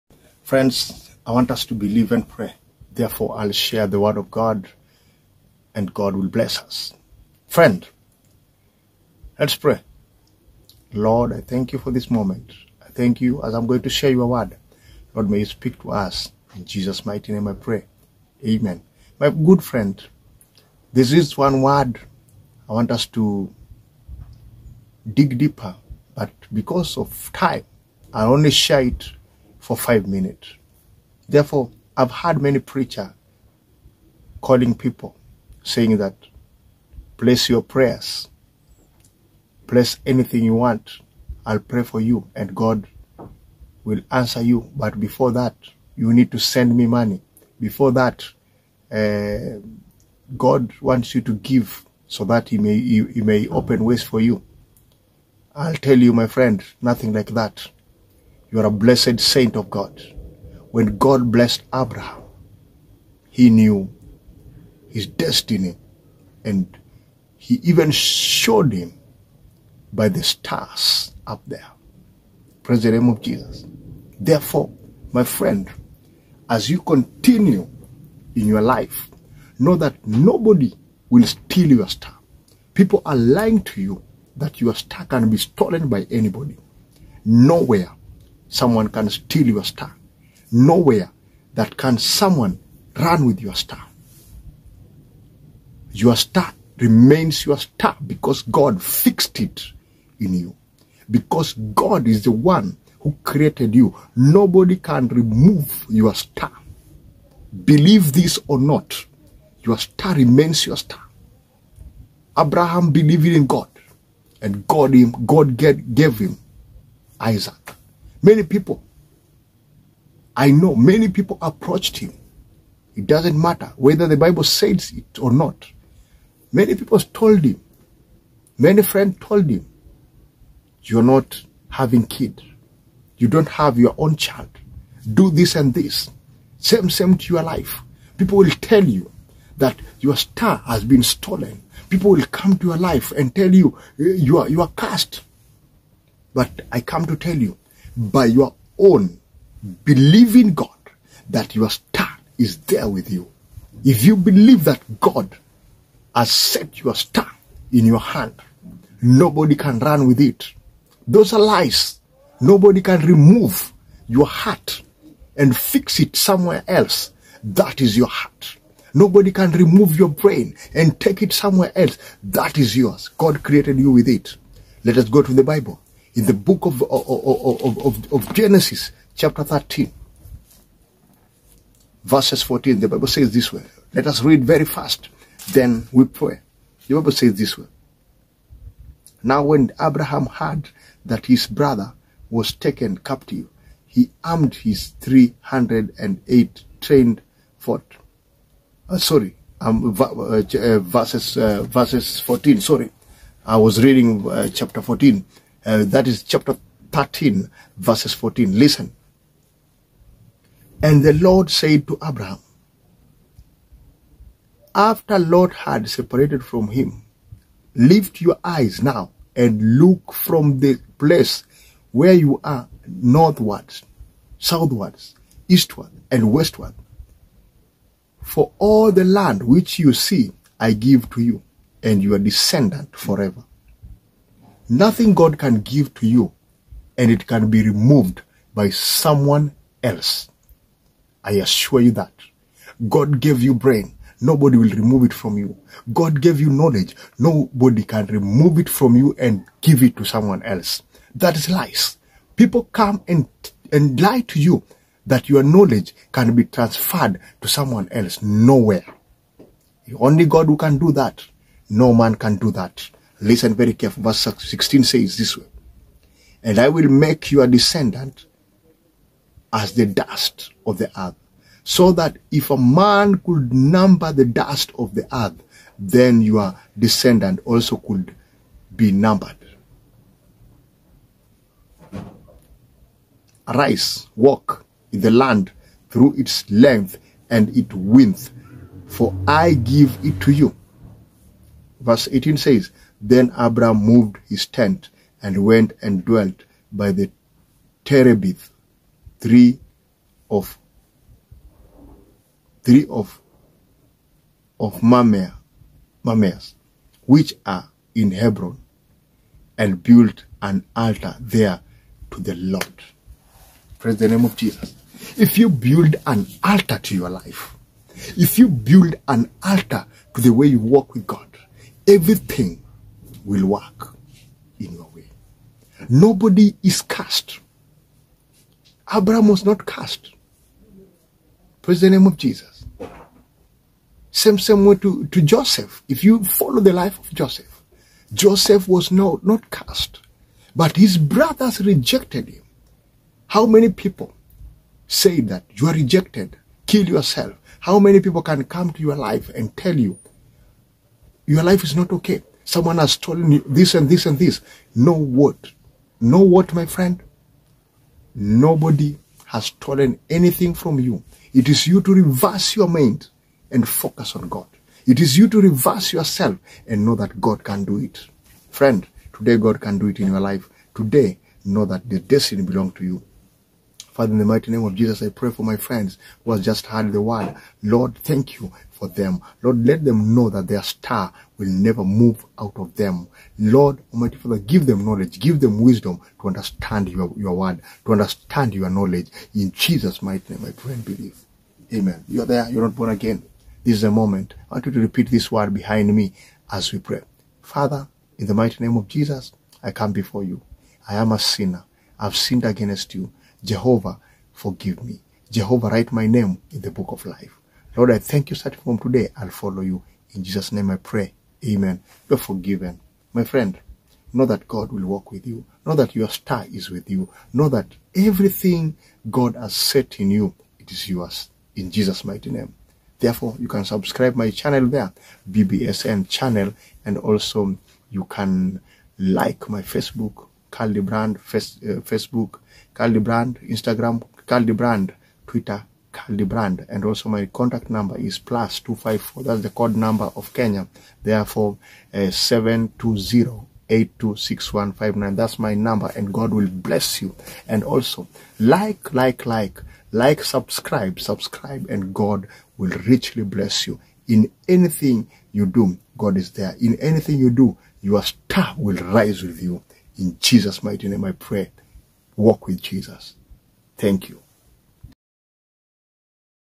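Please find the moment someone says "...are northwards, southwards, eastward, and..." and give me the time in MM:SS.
03:42.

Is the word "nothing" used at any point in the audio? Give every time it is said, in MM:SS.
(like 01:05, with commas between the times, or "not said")
00:56, 03:54.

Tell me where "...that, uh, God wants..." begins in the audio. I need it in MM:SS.
00:47.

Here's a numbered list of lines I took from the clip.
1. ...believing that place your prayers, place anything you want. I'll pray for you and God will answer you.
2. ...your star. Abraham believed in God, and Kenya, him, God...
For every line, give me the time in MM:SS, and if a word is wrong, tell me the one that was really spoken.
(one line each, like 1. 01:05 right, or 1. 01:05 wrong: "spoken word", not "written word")
1. 00:35 wrong: "saying", not "believing"
2. 01:50 wrong: "God", not "Kenya".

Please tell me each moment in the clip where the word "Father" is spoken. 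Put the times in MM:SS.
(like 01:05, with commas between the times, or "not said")
06:14, 06:24, 06:37.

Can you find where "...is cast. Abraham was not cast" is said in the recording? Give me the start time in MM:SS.
05:26.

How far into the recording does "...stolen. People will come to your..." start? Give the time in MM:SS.
02:21.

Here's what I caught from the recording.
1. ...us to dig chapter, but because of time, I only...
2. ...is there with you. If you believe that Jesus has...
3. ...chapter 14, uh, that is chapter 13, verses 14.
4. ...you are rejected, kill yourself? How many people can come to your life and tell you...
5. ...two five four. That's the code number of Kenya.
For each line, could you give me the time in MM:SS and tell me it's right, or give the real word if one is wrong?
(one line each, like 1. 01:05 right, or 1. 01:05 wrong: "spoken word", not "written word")
1. 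00:22 wrong: "deeper", not "chapter"
2. 02:32 wrong: "God", not "Jesus"
3. 03:24 right
4. 05:45 right
5. 07:18 right.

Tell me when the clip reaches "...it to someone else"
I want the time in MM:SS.
04:09.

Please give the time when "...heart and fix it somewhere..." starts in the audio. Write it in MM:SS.
02:44.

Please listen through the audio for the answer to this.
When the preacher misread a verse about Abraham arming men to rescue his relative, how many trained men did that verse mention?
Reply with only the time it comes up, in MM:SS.
03:15.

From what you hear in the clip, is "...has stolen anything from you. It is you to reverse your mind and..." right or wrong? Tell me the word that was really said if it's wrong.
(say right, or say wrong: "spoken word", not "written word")
right.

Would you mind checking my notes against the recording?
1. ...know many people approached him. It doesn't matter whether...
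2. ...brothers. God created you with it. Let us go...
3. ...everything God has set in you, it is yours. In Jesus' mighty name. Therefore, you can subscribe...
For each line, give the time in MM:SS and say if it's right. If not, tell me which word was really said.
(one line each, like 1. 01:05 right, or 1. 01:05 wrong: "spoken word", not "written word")
1. 02:00 right
2. 02:52 wrong: "yours", not "brothers"
3. 06:57 right.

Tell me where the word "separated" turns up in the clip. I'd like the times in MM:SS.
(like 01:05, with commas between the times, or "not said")
03:35.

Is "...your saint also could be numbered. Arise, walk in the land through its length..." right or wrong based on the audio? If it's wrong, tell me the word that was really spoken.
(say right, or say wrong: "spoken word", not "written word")
wrong: "descendant", not "saint".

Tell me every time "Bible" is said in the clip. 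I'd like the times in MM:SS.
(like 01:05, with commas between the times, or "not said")
02:04, 02:55, 03:02, 03:06.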